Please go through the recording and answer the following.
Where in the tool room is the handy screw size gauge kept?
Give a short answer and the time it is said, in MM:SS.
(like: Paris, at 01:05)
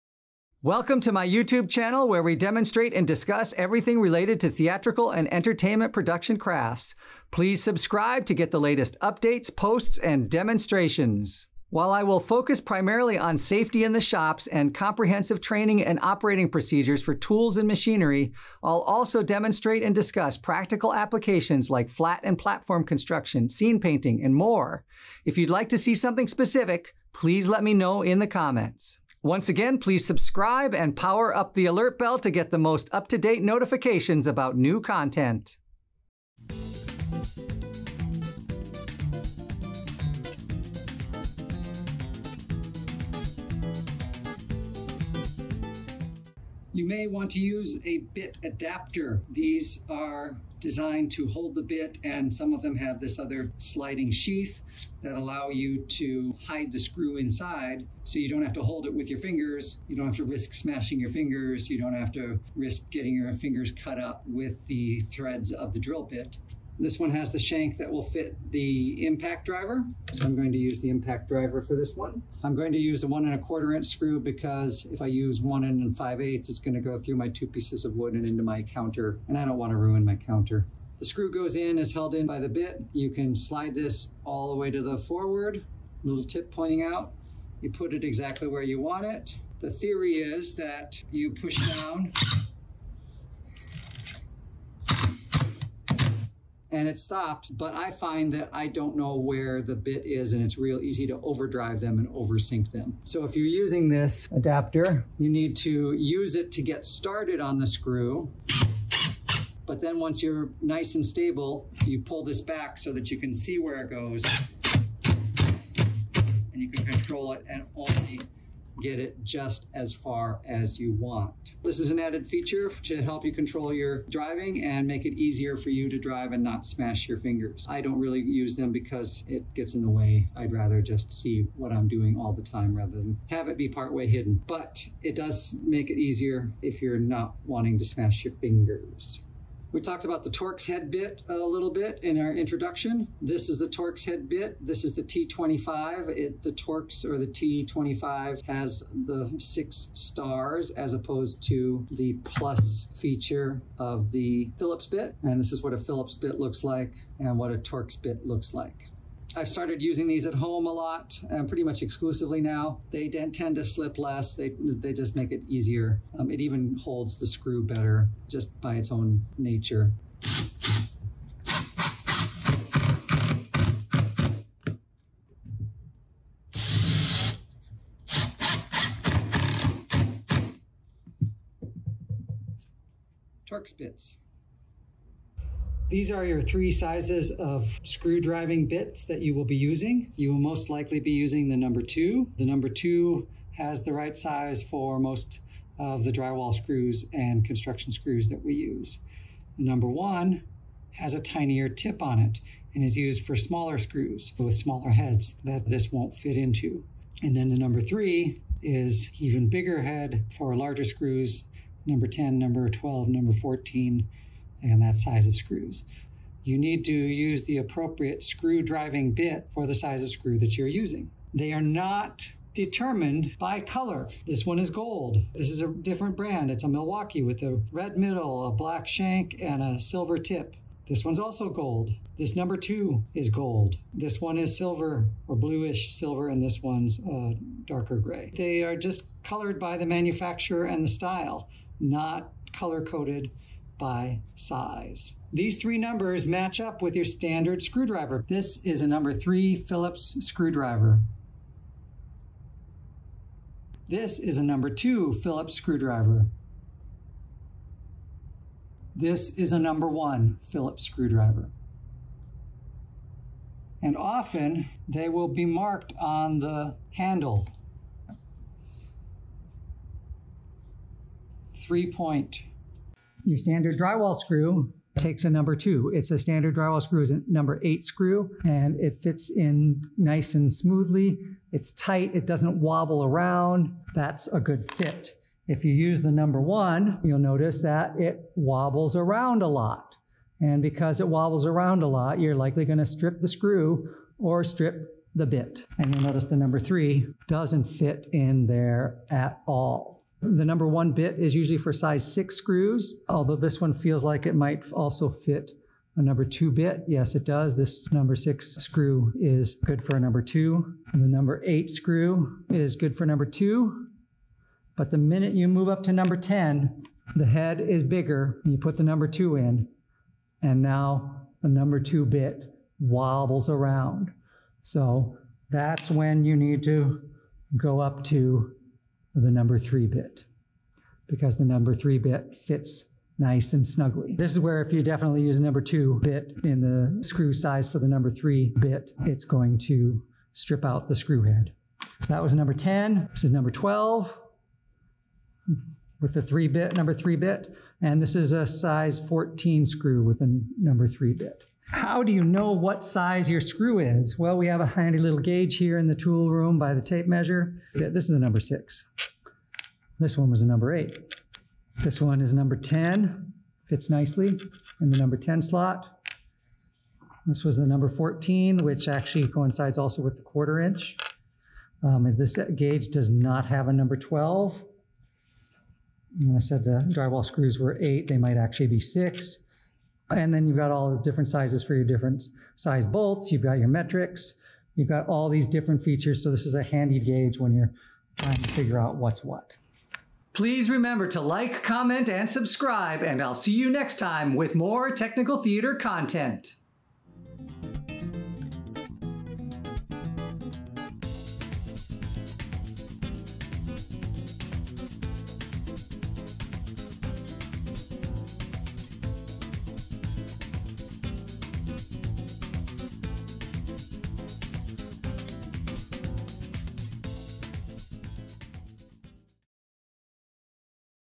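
by the tape measure, at 05:56.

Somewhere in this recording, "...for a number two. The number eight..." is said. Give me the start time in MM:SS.
05:09.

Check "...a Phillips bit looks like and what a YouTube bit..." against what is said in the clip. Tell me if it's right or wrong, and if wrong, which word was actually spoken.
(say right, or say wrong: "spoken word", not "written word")
wrong: "Torx", not "YouTube".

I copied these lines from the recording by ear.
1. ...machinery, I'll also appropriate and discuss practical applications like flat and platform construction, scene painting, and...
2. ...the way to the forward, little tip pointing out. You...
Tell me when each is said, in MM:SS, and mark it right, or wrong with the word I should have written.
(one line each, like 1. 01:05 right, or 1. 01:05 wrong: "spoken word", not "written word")
1. 00:17 wrong: "demonstrate", not "appropriate"
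2. 01:24 right.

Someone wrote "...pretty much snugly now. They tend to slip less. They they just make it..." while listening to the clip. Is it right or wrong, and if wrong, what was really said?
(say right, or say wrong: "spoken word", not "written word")
wrong: "exclusively", not "snugly".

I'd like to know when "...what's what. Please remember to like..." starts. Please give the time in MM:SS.
06:28.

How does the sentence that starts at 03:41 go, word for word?
They are not determined by color.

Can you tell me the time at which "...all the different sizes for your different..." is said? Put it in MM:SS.
06:20.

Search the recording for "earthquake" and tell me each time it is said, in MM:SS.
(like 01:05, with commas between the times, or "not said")
not said.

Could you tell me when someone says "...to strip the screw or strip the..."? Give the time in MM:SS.
04:52.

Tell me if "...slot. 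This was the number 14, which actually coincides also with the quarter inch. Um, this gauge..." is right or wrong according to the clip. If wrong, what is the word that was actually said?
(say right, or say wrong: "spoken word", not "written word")
right.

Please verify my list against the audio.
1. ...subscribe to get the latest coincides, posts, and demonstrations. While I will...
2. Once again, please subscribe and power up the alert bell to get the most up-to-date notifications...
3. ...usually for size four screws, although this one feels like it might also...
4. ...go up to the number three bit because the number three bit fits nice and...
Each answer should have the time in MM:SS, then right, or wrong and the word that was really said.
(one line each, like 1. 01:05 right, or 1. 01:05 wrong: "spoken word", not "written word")
1. 00:07 wrong: "updates", not "coincides"
2. 00:29 right
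3. 05:01 wrong: "six", not "four"
4. 05:27 right.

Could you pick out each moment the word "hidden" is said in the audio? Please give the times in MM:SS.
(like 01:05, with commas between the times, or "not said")
02:14.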